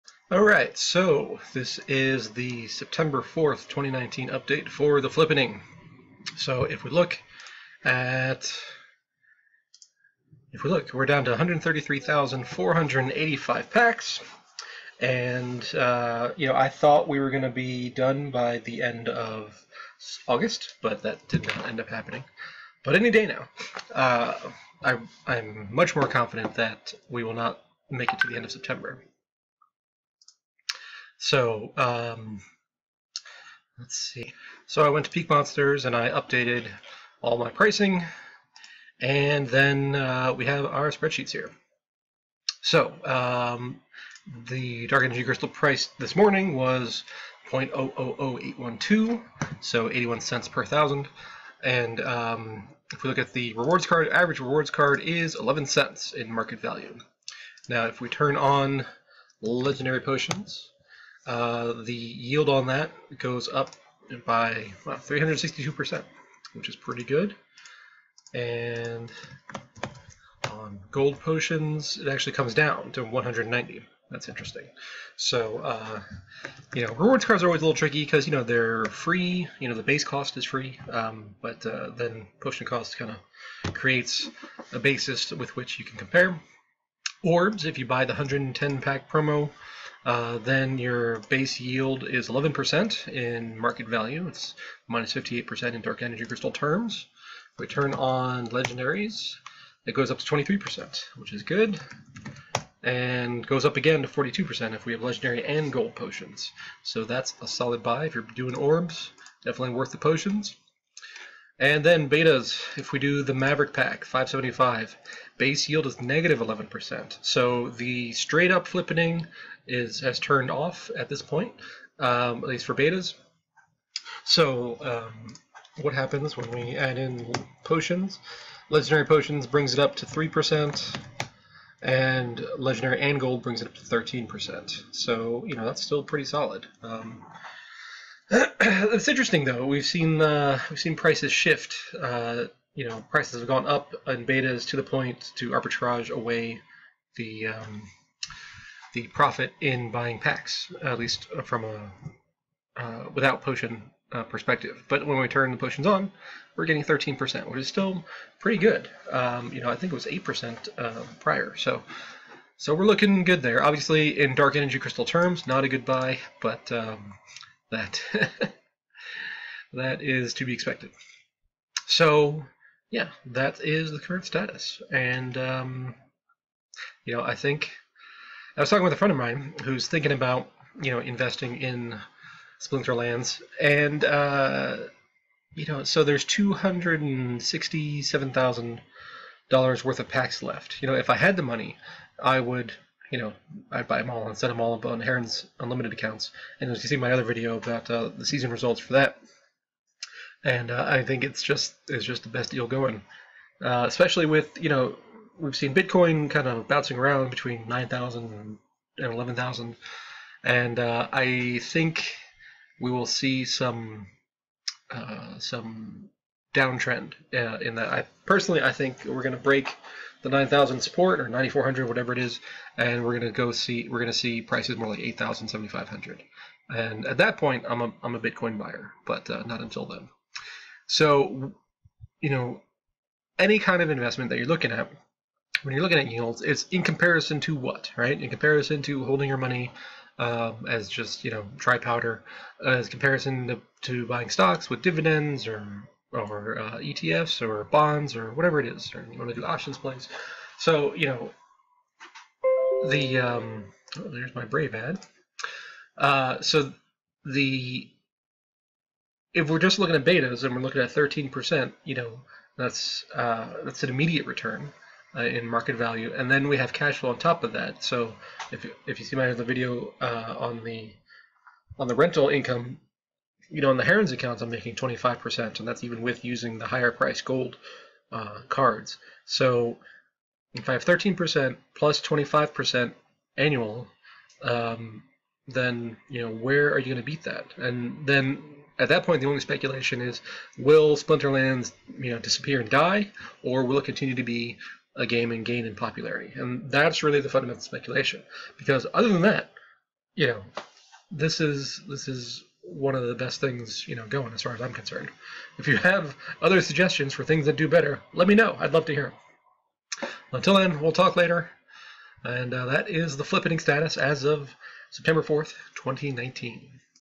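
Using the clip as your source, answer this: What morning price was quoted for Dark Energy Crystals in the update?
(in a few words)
0.000812.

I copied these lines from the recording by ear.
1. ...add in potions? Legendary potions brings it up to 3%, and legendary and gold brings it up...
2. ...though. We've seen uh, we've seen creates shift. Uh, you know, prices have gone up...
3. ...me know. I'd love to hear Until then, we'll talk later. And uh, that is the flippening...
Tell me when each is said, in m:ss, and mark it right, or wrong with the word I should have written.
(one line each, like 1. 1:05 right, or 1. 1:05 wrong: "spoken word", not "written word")
1. 2:06 right
2. 2:19 wrong: "prices", not "creates"
3. 5:08 right.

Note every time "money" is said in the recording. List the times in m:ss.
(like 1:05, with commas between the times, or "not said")
3:11, 3:59.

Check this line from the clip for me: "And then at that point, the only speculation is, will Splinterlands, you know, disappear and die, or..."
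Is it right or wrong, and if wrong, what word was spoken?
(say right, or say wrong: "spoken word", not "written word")
right.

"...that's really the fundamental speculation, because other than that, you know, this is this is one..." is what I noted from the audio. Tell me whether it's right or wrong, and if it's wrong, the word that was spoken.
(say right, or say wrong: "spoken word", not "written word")
right.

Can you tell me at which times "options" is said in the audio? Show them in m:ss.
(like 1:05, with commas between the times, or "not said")
4:09.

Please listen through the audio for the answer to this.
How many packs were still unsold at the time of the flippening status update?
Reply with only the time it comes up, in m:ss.
0:11.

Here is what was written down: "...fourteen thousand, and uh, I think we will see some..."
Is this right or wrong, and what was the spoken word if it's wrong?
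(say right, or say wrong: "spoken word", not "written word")
wrong: "eleven", not "fourteen".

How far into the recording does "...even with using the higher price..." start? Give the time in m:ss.
4:35.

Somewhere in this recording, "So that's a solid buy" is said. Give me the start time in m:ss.
1:46.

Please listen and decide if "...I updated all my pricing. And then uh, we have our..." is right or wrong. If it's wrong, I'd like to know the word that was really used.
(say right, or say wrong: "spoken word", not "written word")
right.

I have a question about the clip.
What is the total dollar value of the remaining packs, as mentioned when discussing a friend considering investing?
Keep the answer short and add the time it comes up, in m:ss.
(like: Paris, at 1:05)
$267,000, at 3:06.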